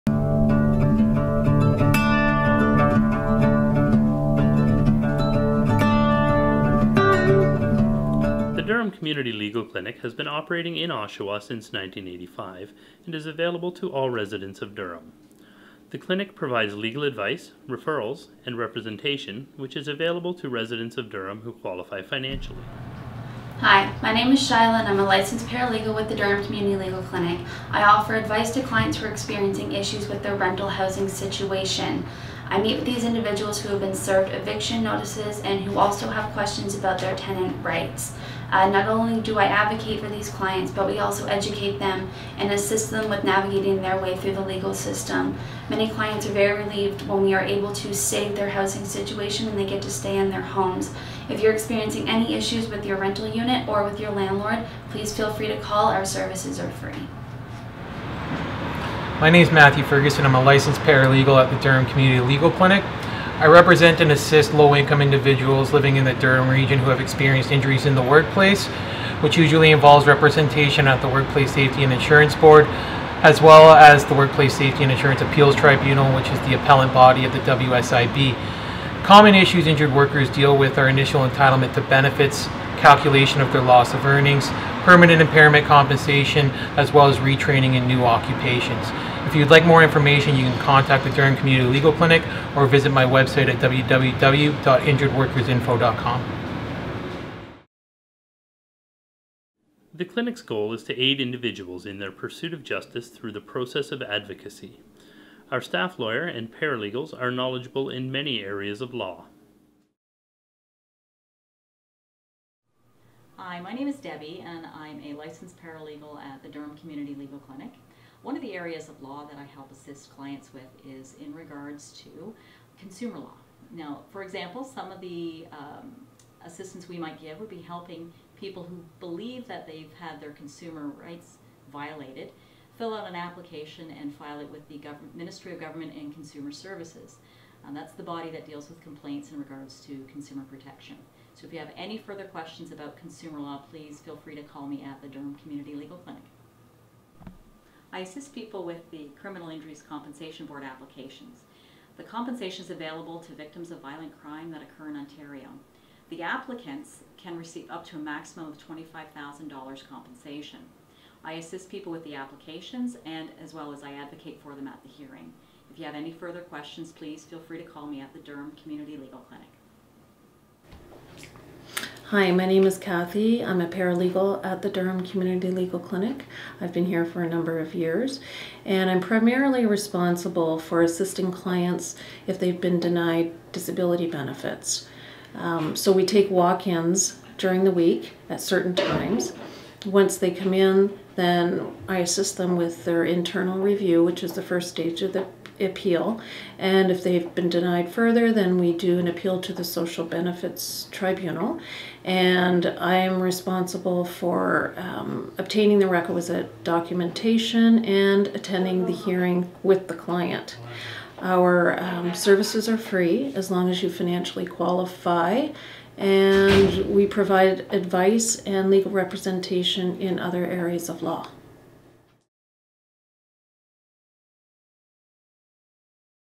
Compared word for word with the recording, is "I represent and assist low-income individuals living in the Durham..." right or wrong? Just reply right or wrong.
right.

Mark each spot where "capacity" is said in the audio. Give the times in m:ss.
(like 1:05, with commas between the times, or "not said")
not said.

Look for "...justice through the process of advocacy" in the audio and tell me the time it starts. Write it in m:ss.
1:42.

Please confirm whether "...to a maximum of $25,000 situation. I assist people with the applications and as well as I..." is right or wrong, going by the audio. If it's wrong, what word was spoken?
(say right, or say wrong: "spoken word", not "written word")
wrong: "compensation", not "situation".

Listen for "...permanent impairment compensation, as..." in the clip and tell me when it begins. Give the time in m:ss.
1:24.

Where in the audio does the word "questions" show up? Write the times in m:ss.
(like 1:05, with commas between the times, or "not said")
0:36, 2:22, 2:46.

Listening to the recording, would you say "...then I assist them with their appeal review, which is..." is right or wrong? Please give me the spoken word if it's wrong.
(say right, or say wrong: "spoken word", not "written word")
wrong: "internal", not "appeal".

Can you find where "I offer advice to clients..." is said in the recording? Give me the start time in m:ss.
0:27.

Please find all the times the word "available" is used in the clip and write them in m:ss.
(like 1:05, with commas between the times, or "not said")
0:13, 0:19, 2:32.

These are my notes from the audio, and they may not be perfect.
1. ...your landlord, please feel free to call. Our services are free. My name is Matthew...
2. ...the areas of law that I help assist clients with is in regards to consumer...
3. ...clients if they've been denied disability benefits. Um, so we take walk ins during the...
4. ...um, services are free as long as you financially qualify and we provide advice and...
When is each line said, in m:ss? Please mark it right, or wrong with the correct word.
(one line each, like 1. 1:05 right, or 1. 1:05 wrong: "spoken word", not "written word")
1. 0:54 right
2. 1:58 right
3. 3:01 right
4. 3:31 right.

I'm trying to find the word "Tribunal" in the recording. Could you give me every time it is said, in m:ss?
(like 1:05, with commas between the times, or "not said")
1:15, 3:20.